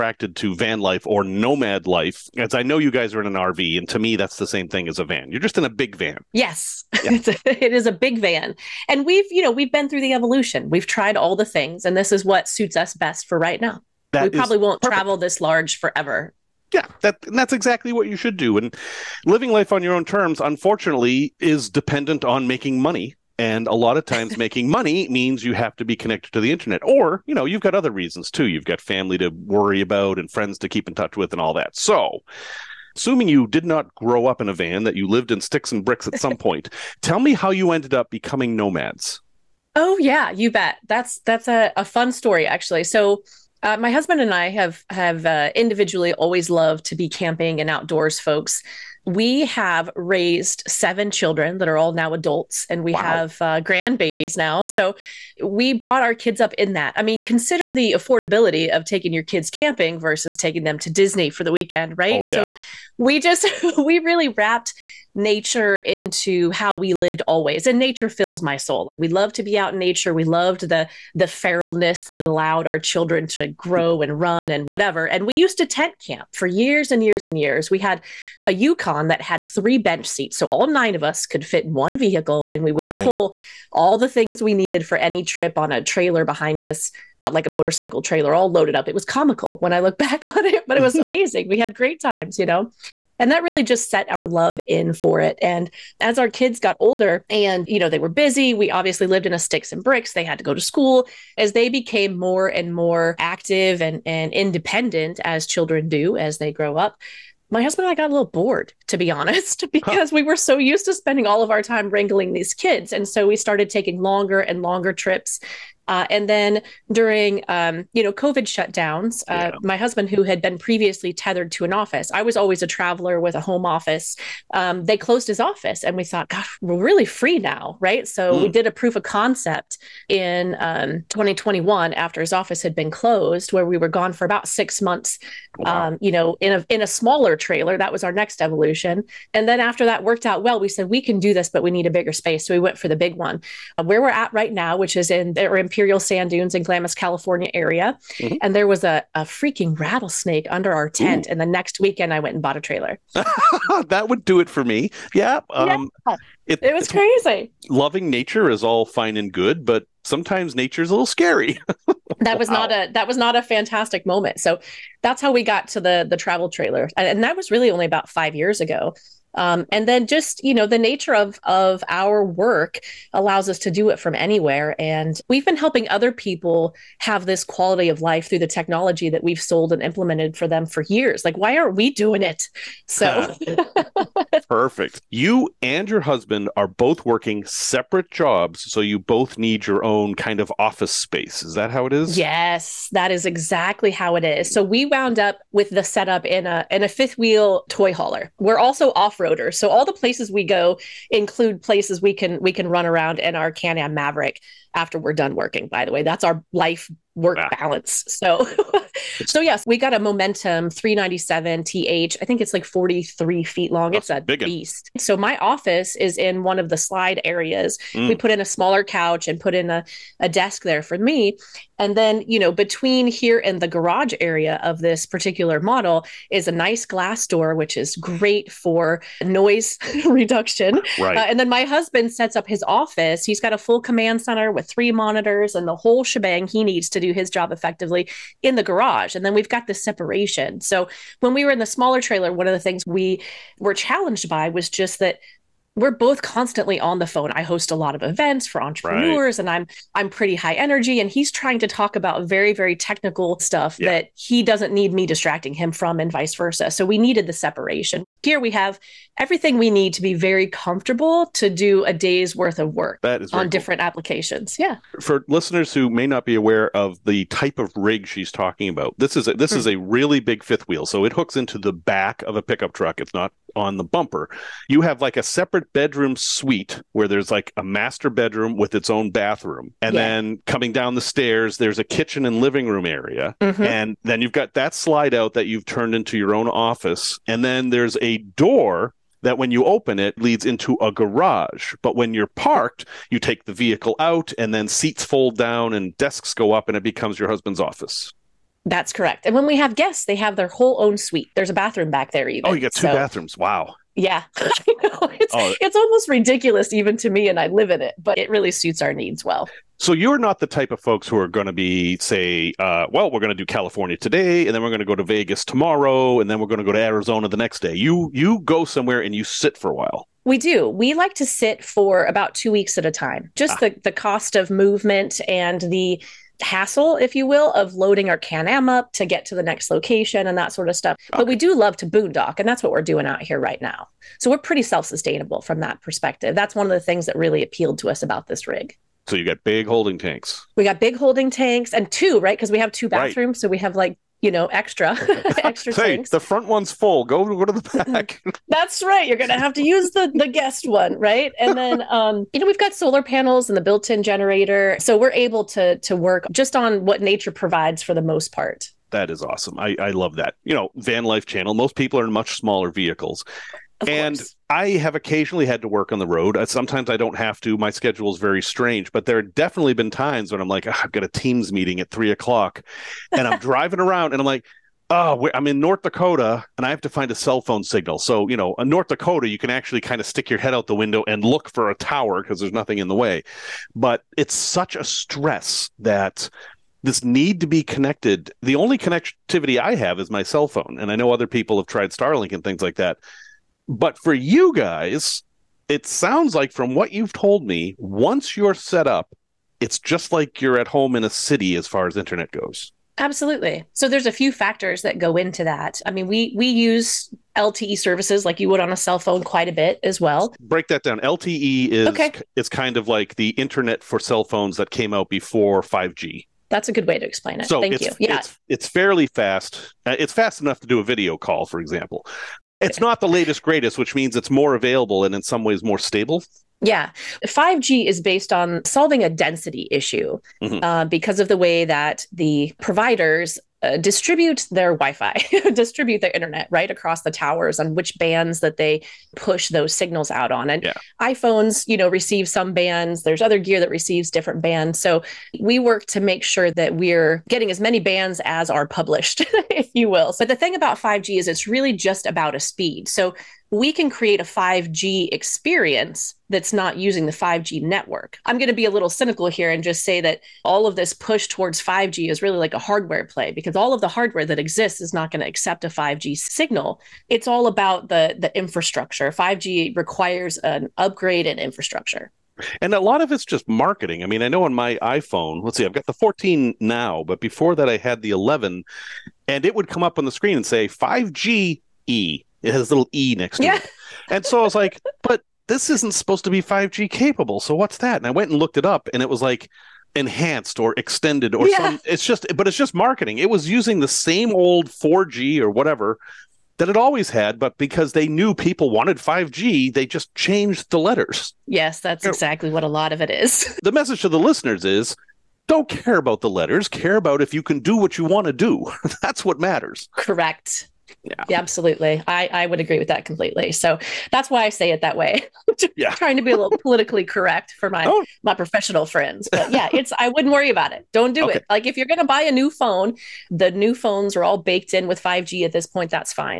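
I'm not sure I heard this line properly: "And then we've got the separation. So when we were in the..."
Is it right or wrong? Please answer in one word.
right.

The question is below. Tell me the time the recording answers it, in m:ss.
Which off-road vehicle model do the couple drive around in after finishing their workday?
3:23.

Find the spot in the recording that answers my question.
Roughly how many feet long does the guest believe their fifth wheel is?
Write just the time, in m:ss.
3:32.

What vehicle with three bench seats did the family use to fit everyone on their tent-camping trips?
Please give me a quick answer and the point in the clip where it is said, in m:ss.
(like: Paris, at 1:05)
Yukon, at 1:18.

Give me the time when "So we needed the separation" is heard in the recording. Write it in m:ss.
4:16.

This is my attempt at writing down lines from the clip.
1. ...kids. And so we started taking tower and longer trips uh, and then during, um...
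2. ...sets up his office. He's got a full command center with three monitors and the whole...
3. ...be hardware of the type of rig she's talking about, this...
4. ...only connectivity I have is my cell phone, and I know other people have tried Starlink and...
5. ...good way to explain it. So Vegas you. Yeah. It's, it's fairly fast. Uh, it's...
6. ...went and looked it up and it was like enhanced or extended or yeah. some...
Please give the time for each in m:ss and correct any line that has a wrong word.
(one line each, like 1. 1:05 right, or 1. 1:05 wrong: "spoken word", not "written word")
1. 1:52 wrong: "longer", not "tower"
2. 3:52 right
3. 4:26 wrong: "aware", not "hardware"
4. 6:28 right
5. 6:56 wrong: "Thank", not "Vegas"
6. 8:08 right.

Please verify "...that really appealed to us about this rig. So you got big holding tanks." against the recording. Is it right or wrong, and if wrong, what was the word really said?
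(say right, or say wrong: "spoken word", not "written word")
right.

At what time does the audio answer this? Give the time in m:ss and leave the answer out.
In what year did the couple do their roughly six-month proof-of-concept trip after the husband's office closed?
2:11.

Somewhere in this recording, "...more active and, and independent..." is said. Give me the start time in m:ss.
1:42.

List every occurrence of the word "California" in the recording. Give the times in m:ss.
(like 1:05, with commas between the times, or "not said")
2:26, 5:13.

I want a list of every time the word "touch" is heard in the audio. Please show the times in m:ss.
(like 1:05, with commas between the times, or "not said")
0:30.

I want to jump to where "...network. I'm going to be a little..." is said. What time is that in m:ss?
7:37.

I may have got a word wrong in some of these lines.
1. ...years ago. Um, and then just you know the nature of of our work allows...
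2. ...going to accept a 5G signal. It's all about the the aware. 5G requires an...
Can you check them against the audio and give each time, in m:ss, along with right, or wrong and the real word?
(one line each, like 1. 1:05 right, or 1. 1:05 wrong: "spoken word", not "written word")
1. 2:48 right
2. 7:45 wrong: "infrastructure", not "aware".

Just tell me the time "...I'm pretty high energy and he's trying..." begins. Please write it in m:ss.
4:09.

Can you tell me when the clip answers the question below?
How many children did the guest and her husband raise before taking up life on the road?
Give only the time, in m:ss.
0:50.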